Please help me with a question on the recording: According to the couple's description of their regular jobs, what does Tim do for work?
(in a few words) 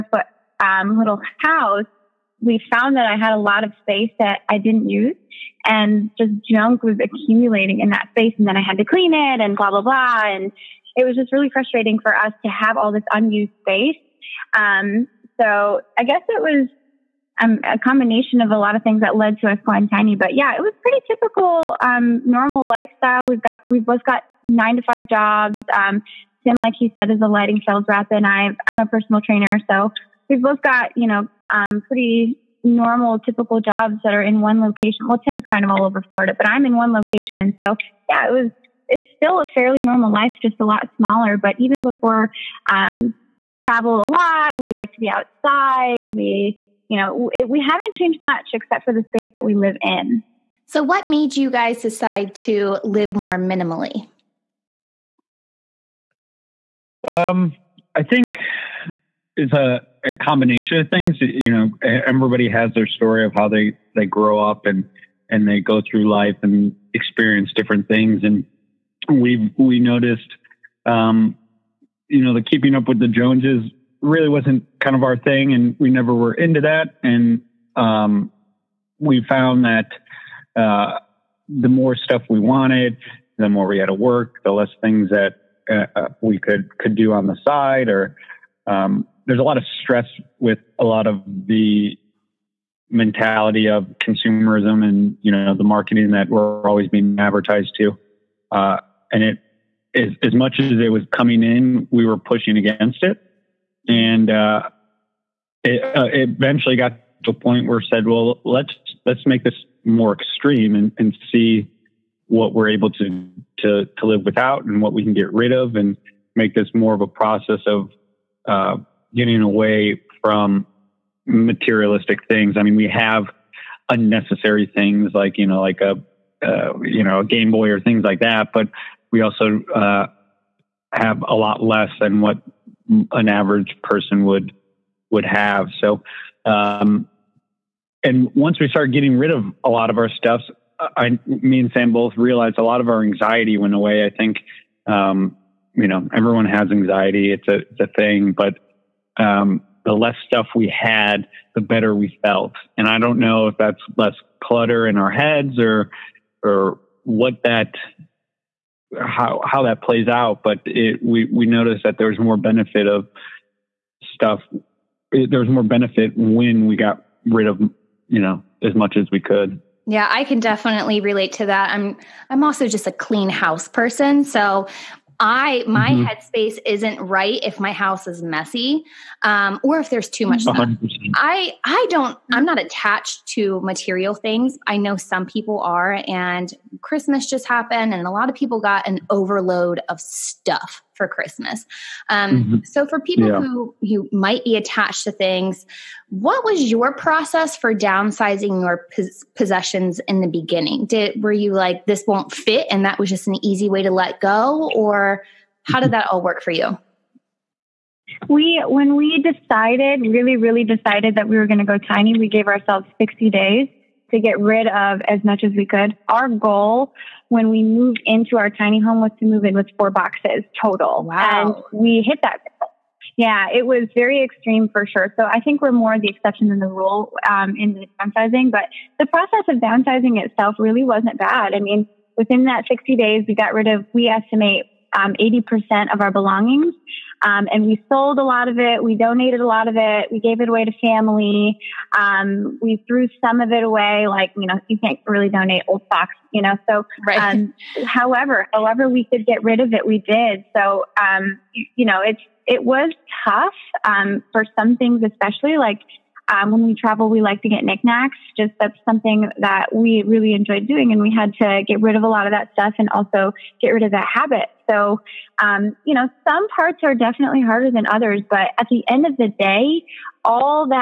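lighting sales rep.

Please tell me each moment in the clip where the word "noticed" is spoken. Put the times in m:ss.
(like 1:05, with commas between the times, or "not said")
1:09, 2:41.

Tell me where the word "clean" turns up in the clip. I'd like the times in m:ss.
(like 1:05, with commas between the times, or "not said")
0:08, 2:52.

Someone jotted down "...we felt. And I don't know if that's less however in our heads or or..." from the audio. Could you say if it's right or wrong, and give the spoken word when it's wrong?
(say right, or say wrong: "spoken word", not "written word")
wrong: "clutter", not "however".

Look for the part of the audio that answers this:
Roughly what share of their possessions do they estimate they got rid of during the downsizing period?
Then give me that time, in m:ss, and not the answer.
3:55.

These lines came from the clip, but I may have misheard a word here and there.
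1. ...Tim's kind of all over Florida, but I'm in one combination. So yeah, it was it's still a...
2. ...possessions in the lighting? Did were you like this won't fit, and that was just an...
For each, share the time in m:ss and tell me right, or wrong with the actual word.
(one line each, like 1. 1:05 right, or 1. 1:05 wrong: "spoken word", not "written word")
1. 0:35 wrong: "location", not "combination"
2. 3:19 wrong: "beginning", not "lighting".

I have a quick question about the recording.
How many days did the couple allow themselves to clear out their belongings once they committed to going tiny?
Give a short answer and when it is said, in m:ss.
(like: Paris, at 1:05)
60, at 3:32.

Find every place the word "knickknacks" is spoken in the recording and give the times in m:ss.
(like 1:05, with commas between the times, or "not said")
4:17.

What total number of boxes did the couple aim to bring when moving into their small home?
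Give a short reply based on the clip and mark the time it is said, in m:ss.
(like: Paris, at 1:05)
4, at 3:39.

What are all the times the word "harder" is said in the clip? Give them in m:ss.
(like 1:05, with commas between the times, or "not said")
4:27.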